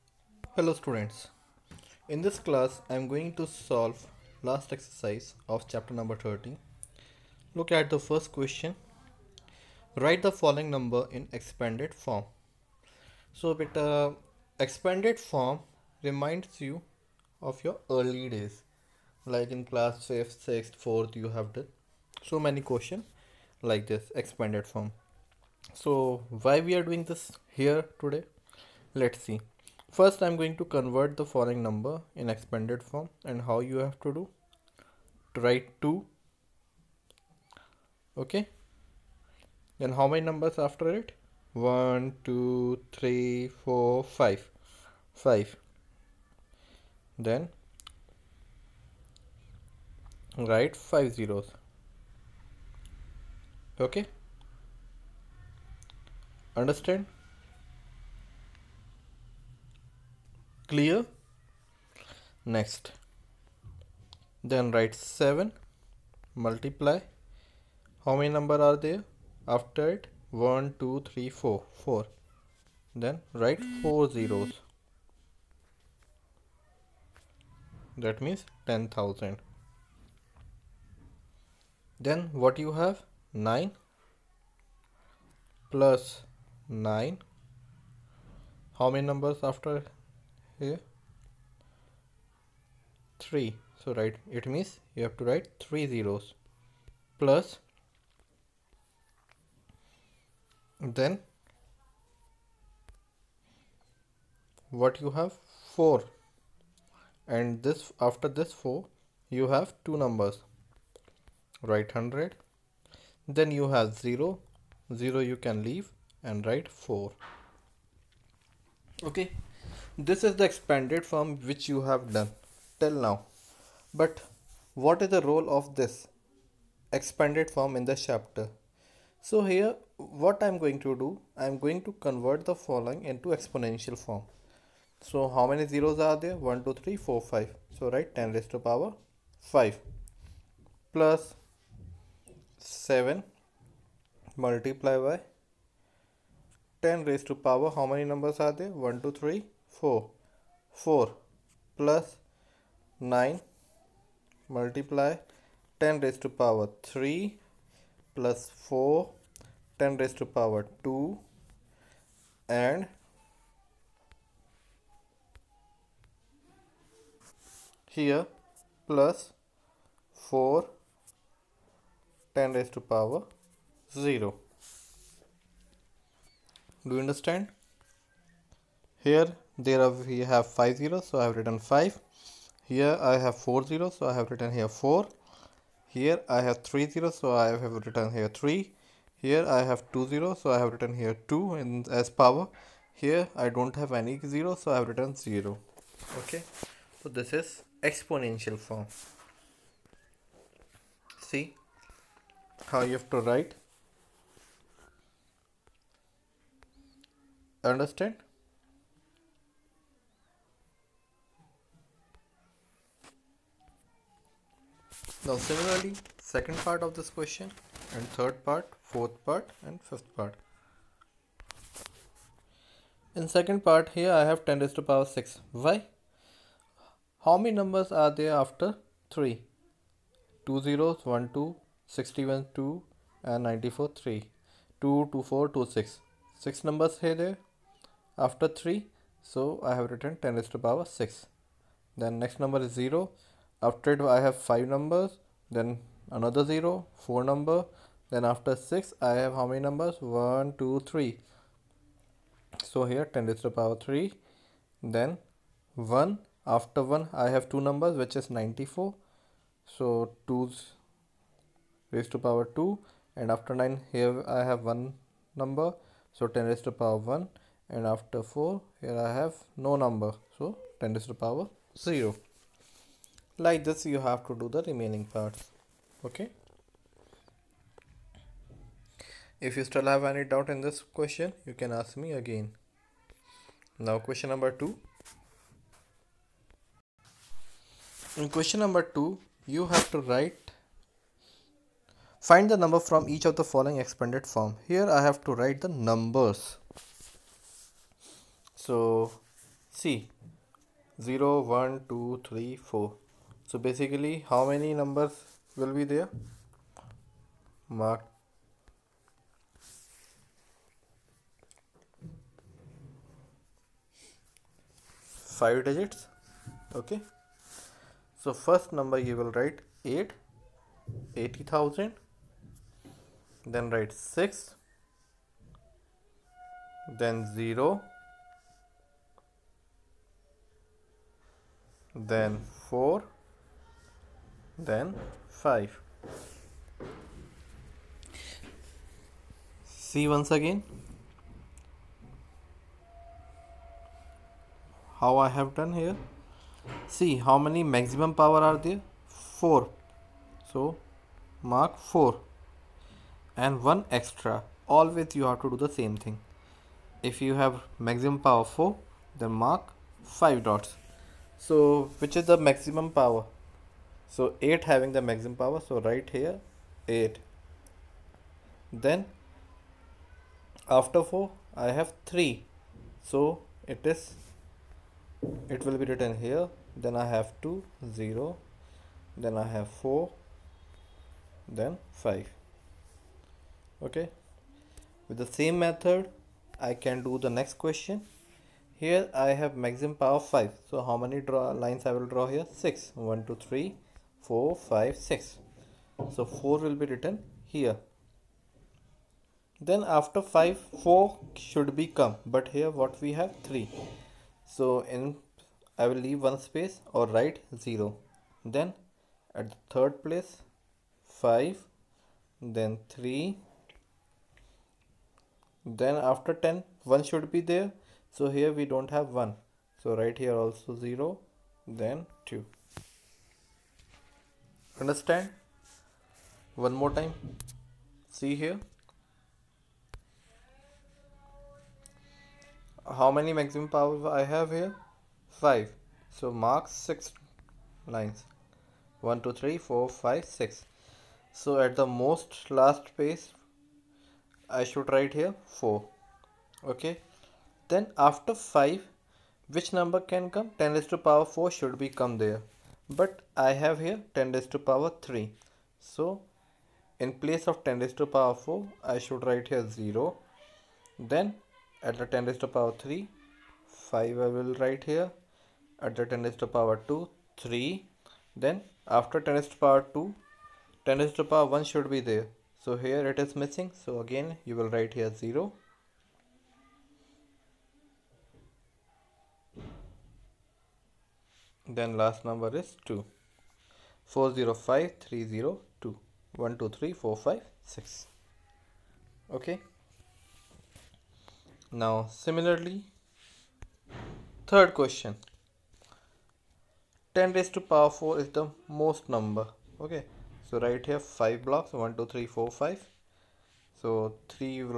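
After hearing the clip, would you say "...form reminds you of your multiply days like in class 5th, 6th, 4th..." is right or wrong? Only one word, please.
wrong.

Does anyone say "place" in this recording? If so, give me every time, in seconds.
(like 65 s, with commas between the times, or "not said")
410 s, 442 s, 457 s.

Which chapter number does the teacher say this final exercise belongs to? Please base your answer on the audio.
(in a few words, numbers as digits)
30.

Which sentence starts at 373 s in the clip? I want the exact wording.
So it is it will be written here.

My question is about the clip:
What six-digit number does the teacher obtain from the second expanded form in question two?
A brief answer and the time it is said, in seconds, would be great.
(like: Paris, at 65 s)
405302, at 484 s.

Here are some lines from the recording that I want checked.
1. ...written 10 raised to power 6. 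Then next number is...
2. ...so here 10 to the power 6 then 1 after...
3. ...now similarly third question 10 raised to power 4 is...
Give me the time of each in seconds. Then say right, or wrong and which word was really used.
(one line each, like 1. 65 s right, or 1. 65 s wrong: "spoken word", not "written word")
1. 239 s right
2. 252 s wrong: "3", not "6"
3. 491 s right.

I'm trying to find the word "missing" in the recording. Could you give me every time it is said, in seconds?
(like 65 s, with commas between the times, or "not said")
473 s.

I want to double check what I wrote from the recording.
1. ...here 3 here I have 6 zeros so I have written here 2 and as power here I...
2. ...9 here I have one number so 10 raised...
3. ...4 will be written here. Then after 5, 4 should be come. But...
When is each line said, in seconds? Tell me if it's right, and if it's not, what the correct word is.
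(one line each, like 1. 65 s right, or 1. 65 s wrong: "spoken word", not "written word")
1. 188 s wrong: "2", not "6"
2. 263 s right
3. 396 s right.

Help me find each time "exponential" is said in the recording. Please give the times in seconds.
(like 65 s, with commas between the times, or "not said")
133 s, 197 s.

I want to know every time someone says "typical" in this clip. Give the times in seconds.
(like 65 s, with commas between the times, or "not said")
not said.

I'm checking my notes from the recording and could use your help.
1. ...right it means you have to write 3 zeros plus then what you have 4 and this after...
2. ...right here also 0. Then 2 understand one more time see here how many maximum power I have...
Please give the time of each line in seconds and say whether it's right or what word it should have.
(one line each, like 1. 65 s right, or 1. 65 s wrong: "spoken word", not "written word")
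1. 93 s right
2. 419 s right.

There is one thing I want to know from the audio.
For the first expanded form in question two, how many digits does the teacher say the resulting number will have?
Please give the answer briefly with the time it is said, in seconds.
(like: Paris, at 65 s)
5, at 315 s.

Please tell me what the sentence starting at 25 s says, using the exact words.
So why we are doing this here today?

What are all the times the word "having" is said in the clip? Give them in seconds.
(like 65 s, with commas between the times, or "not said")
364 s.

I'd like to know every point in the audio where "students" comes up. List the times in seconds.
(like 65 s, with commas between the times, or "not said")
0 s.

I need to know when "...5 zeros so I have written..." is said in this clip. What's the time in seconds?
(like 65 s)
180 s.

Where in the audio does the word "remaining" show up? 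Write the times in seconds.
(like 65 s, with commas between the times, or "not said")
274 s.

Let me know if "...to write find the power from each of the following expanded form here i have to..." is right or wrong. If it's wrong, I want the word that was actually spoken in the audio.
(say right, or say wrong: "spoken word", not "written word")
wrong: "number", not "power".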